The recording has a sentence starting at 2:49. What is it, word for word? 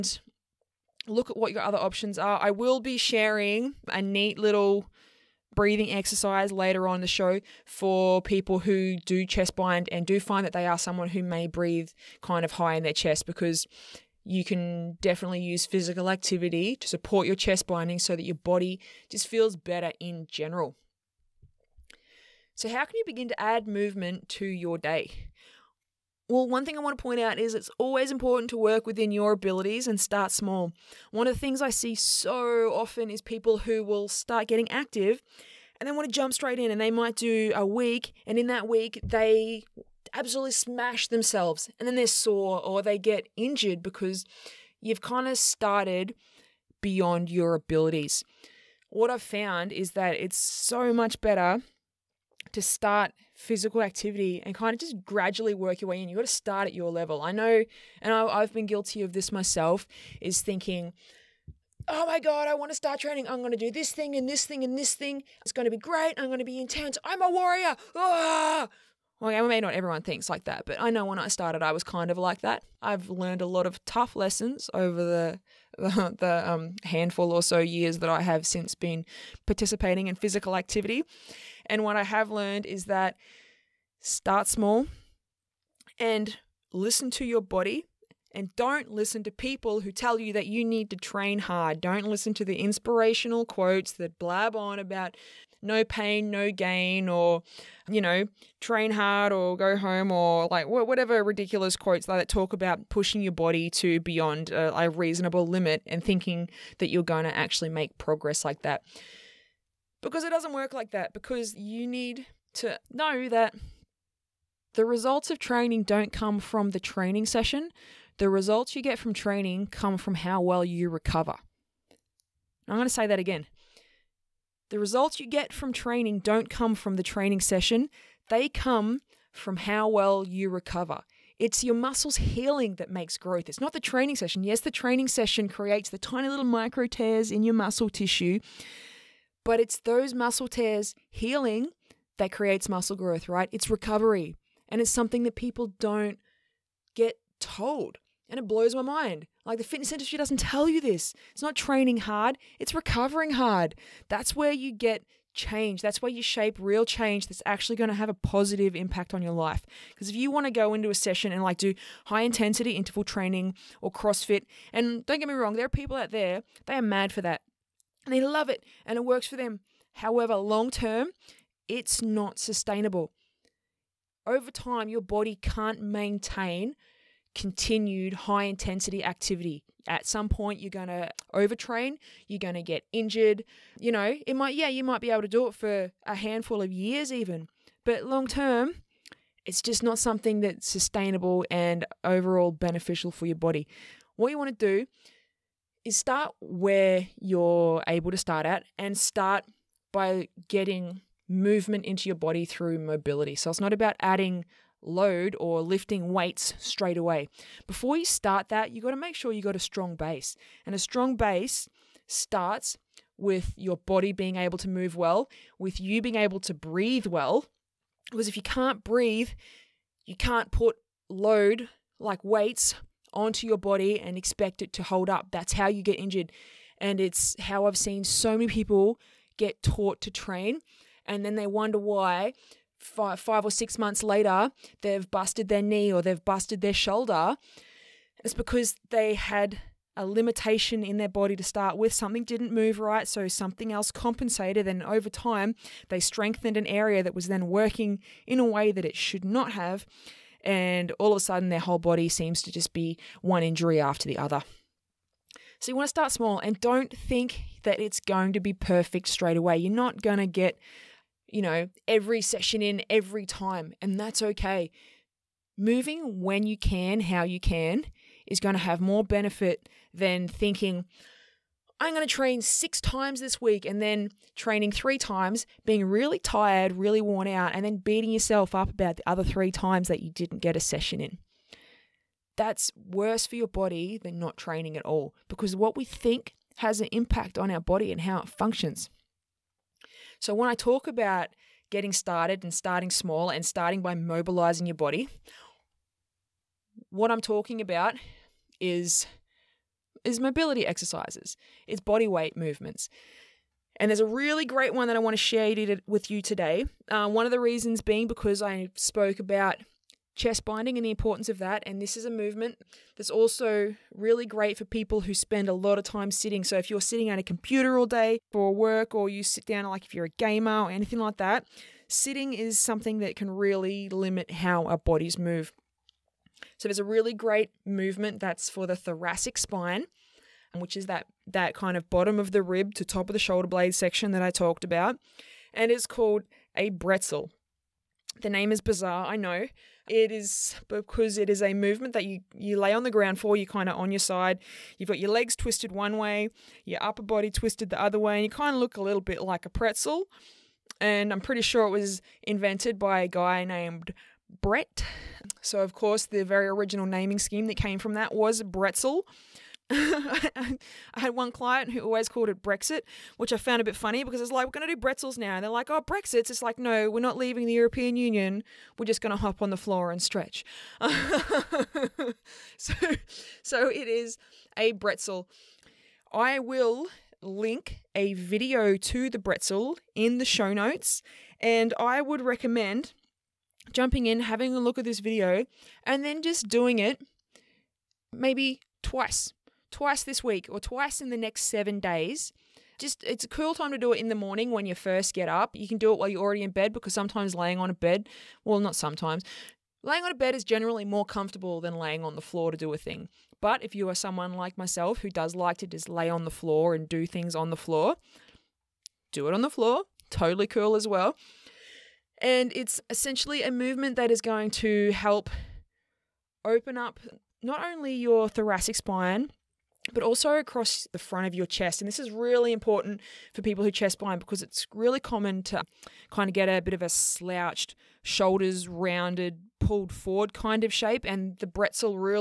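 However, long term, it's not sustainable.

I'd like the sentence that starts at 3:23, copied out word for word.
So it's not about adding load or lifting weights straight away.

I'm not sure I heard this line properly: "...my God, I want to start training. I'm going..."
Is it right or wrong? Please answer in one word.
right.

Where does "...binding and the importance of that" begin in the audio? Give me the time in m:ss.
5:10.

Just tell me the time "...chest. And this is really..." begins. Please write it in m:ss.
7:01.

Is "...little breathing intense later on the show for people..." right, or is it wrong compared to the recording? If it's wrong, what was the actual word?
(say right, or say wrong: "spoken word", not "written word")
wrong: "exercise", not "intense".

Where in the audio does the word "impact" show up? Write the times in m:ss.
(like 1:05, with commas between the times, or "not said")
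2:38, 4:46.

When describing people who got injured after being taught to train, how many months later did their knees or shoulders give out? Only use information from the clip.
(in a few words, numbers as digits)
5 or 6 months.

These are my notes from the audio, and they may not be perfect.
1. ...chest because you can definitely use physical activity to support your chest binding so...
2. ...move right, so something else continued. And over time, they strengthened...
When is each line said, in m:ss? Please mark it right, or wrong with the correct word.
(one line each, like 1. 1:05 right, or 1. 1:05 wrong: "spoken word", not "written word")
1. 0:12 right
2. 4:02 wrong: "compensated", not "continued".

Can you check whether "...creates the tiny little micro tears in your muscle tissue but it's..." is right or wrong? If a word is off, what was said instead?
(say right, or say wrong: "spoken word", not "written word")
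right.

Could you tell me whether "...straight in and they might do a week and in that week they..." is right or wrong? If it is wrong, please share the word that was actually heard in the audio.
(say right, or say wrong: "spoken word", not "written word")
right.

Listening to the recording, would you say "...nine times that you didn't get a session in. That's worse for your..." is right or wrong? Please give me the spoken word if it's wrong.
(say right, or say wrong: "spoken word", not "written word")
wrong: "three", not "nine".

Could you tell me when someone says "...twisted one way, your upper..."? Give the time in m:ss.
5:45.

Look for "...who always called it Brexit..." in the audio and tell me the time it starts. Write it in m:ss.
6:01.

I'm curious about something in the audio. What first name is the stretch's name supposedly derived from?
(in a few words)
Brett.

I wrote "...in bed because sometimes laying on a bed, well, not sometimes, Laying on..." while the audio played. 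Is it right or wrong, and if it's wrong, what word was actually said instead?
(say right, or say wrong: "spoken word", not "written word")
right.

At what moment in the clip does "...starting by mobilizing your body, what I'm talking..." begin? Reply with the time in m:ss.
4:53.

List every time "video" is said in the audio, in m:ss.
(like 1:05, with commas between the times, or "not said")
6:18, 6:24.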